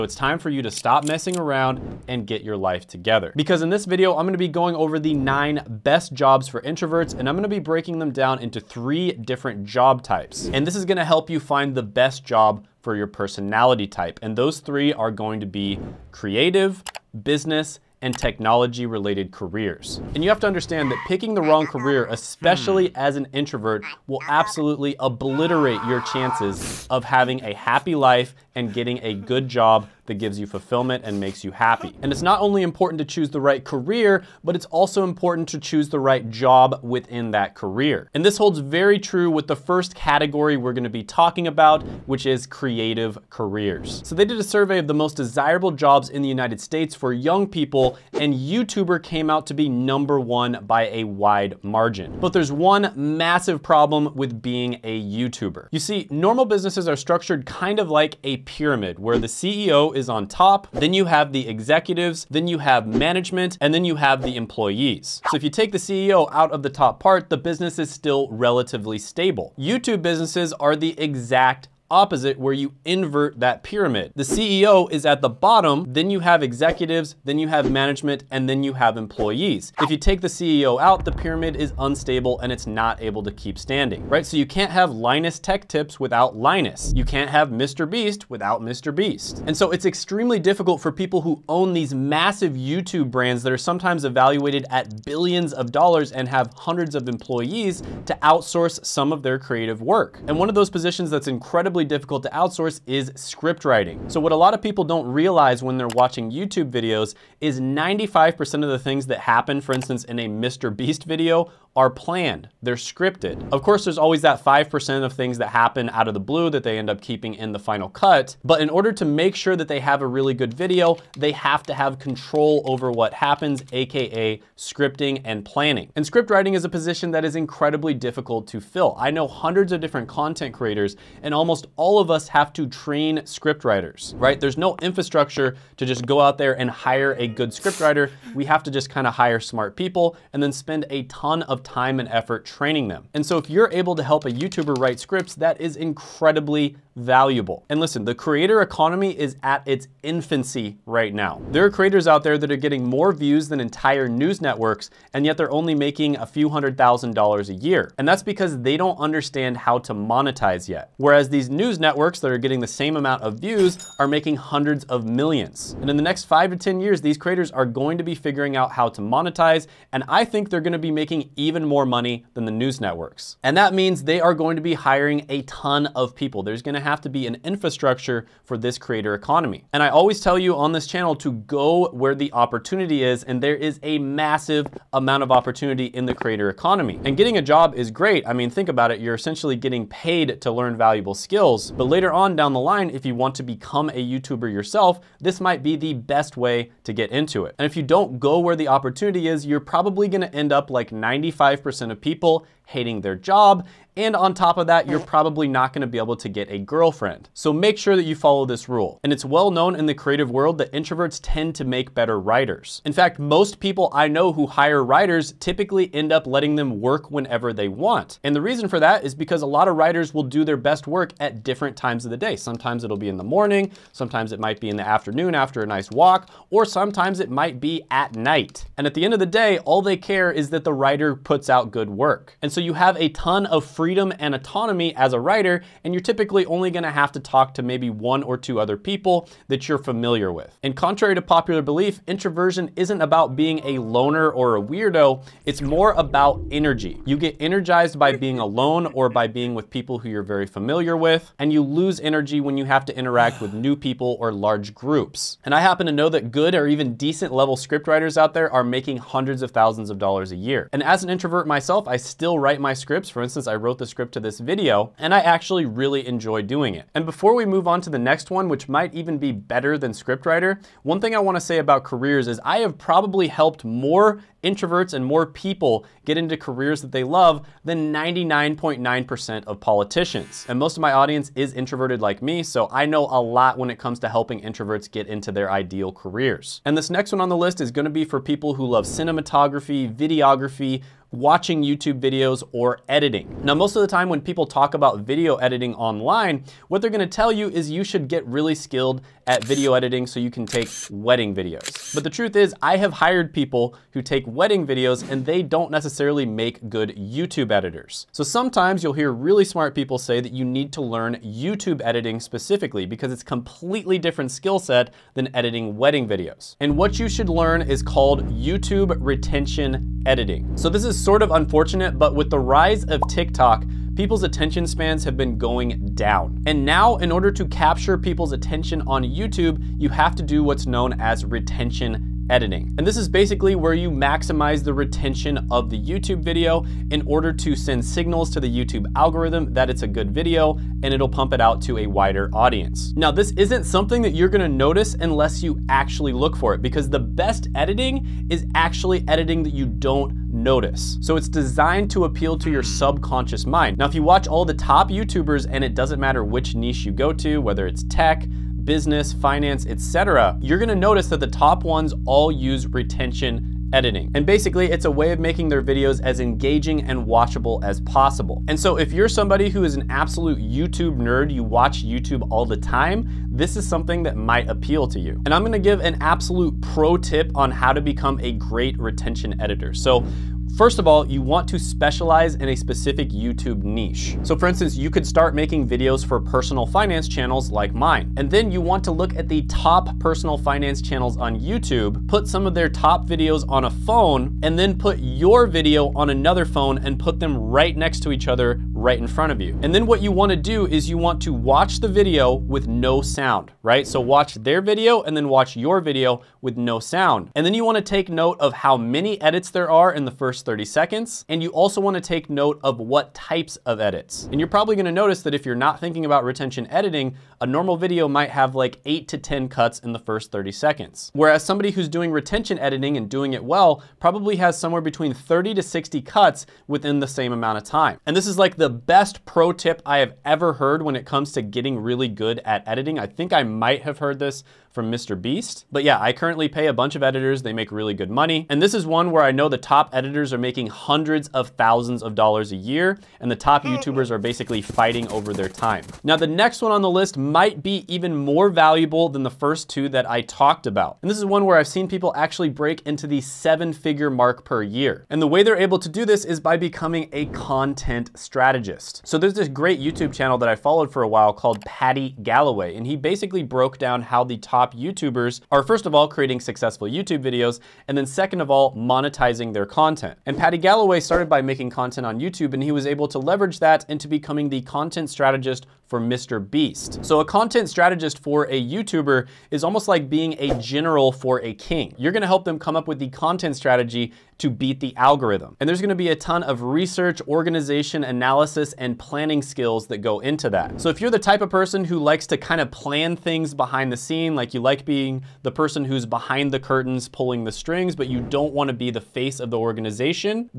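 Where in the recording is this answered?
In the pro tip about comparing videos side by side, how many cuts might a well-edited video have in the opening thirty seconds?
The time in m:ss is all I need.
7:05.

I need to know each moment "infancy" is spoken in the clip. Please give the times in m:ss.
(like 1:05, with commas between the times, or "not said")
2:30.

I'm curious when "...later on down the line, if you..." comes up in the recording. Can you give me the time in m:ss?
3:11.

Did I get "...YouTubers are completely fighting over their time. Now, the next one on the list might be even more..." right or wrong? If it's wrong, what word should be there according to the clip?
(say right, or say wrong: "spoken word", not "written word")
wrong: "basically", not "completely".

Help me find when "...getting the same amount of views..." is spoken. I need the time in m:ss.
2:42.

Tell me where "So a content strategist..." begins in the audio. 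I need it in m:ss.
7:57.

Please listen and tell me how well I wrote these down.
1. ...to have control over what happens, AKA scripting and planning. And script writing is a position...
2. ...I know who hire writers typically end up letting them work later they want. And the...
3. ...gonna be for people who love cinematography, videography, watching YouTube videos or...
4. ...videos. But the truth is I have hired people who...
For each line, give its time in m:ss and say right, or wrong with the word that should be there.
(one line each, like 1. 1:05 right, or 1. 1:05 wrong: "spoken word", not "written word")
1. 2:01 right
2. 3:33 wrong: "whenever", not "later"
3. 4:47 right
4. 5:01 right.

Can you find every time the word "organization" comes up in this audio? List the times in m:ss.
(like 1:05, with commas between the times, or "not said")
8:07, 8:19.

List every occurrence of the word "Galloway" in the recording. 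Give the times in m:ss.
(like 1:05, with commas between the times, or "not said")
7:42, 7:50.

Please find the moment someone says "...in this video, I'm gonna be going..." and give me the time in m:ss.
0:03.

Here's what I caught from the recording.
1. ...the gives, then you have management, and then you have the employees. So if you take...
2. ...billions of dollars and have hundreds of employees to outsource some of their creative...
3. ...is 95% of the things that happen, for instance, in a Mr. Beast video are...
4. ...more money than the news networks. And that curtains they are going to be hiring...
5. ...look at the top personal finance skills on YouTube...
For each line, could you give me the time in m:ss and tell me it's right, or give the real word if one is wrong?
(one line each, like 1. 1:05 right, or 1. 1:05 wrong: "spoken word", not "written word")
1. 1:01 wrong: "executives", not "gives"
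2. 1:35 right
3. 1:47 right
4. 2:51 wrong: "means", not "curtains"
5. 6:28 wrong: "channels", not "skills".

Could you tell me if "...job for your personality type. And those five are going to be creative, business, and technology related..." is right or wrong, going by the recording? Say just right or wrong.
wrong.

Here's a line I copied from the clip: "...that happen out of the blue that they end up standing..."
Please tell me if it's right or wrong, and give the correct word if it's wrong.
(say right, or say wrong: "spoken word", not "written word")
wrong: "keeping", not "standing".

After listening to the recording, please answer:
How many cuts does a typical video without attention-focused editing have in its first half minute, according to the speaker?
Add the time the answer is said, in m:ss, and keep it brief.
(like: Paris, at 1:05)
8 to 10, at 6:58.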